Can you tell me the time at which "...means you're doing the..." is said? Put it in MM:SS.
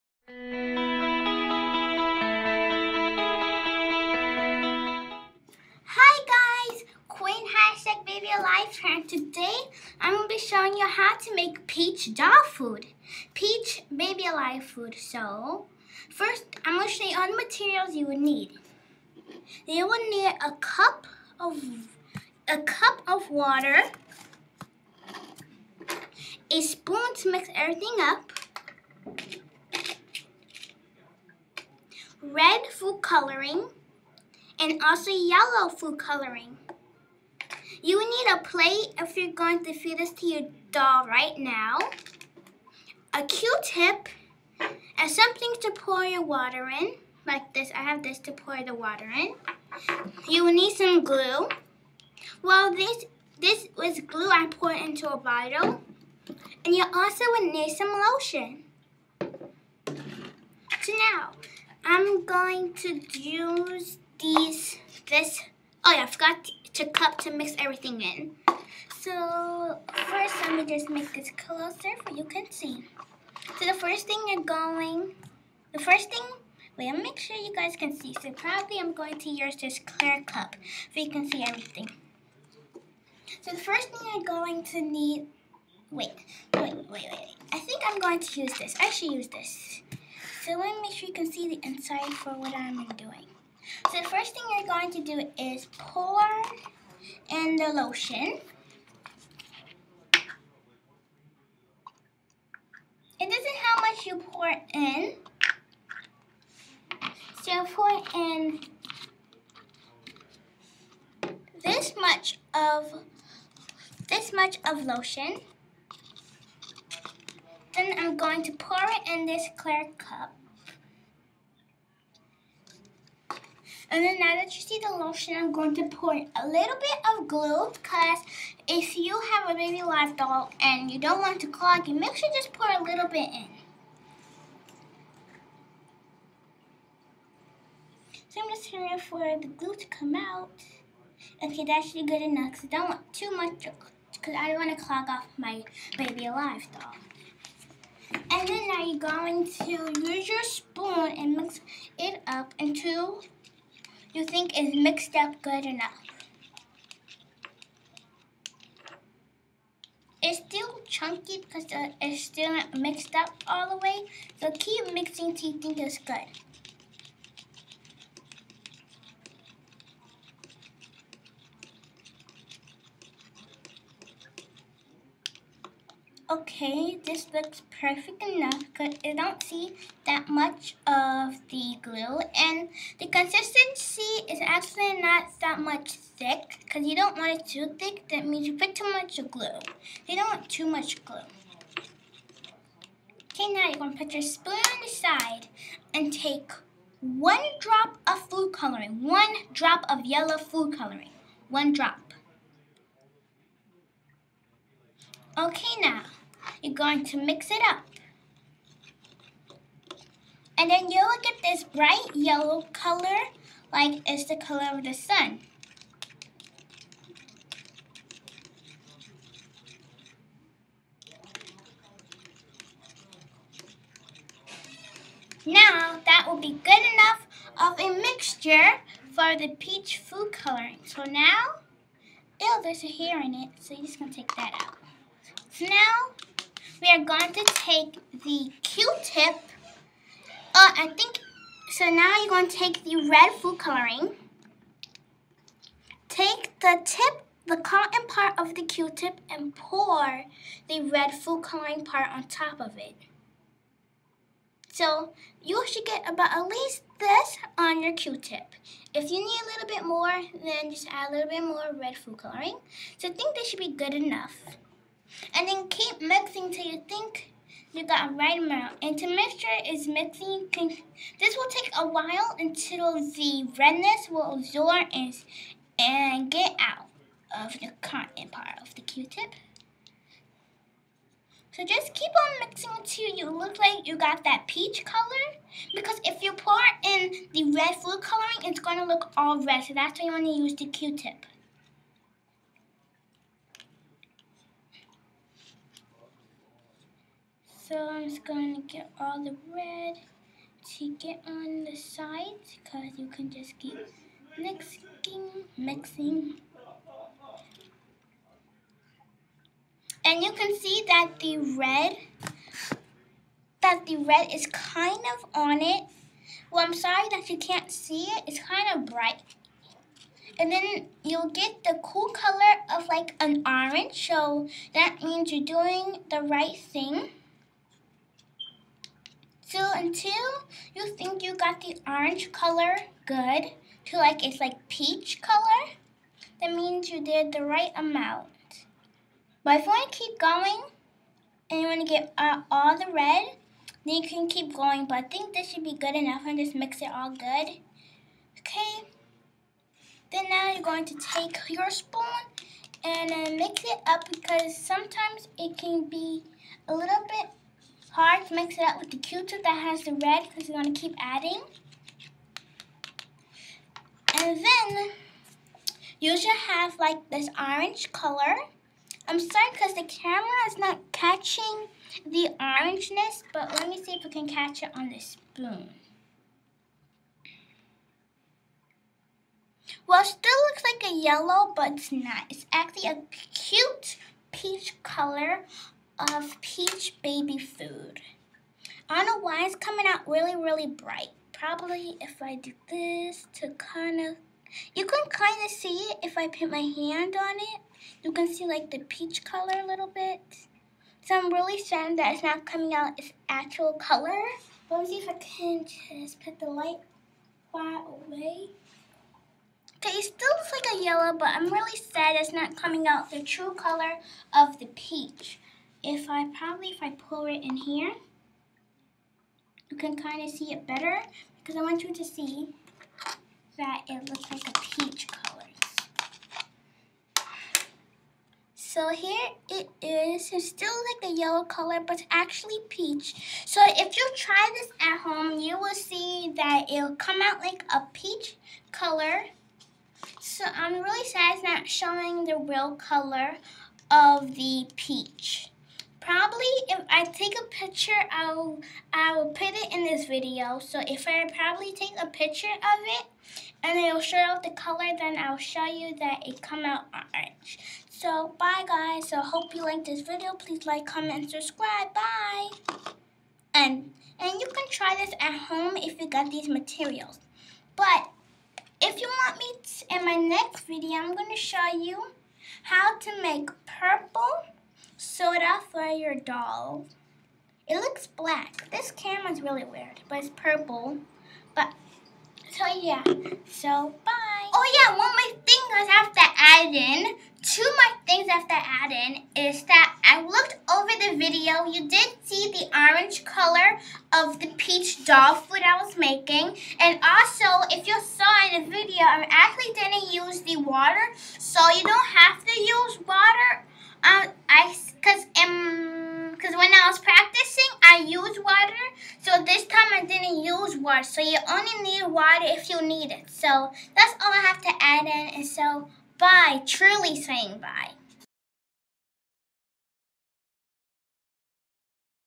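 05:25.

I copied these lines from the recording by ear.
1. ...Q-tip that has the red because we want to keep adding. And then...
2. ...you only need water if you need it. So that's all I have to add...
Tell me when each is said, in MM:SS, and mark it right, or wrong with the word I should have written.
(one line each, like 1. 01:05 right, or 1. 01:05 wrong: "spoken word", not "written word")
1. 05:58 right
2. 08:31 right.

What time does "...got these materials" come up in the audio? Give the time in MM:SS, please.
07:46.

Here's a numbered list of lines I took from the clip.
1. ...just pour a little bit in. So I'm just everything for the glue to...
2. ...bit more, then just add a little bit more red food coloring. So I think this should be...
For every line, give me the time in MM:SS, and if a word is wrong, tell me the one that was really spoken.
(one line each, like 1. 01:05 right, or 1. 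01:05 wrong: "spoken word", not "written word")
1. 02:12 wrong: "waiting", not "everything"
2. 04:19 right.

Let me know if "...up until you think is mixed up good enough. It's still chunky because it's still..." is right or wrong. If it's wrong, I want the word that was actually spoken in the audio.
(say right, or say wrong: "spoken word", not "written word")
right.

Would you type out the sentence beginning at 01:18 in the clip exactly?
So probably I'm going to use this clear cup so you can see everything.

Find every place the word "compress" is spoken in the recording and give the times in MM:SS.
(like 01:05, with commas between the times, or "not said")
not said.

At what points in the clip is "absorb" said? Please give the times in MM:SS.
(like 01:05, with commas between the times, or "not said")
04:34.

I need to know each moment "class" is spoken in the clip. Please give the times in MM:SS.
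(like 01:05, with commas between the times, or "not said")
not said.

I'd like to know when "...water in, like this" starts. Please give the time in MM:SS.
00:46.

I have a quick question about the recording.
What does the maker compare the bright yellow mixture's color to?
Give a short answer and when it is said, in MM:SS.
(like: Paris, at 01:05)
The sun, at 03:34.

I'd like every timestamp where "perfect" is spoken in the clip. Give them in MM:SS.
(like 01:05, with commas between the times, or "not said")
02:57.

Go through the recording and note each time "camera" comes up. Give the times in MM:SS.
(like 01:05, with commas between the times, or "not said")
06:09, 07:58.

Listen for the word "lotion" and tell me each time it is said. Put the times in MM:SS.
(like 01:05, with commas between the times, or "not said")
00:57, 01:37, 01:54, 02:04.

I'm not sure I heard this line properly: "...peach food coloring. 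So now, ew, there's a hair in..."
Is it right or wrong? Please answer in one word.
right.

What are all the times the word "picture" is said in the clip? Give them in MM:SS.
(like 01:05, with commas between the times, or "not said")
07:27, 07:32.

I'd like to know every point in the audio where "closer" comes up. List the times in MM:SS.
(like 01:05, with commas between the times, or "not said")
01:11.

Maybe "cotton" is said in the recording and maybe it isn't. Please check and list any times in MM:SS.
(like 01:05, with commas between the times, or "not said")
04:07, 04:37.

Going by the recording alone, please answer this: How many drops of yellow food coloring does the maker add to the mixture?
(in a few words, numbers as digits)
1.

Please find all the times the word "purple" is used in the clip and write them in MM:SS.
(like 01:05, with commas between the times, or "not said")
07:53, 08:00.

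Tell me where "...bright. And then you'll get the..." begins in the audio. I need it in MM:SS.
05:18.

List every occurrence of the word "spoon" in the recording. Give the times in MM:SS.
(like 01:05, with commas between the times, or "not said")
00:26, 02:30, 03:14, 05:51, 06:14.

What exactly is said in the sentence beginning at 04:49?
So that's why you want to use the Q-tip.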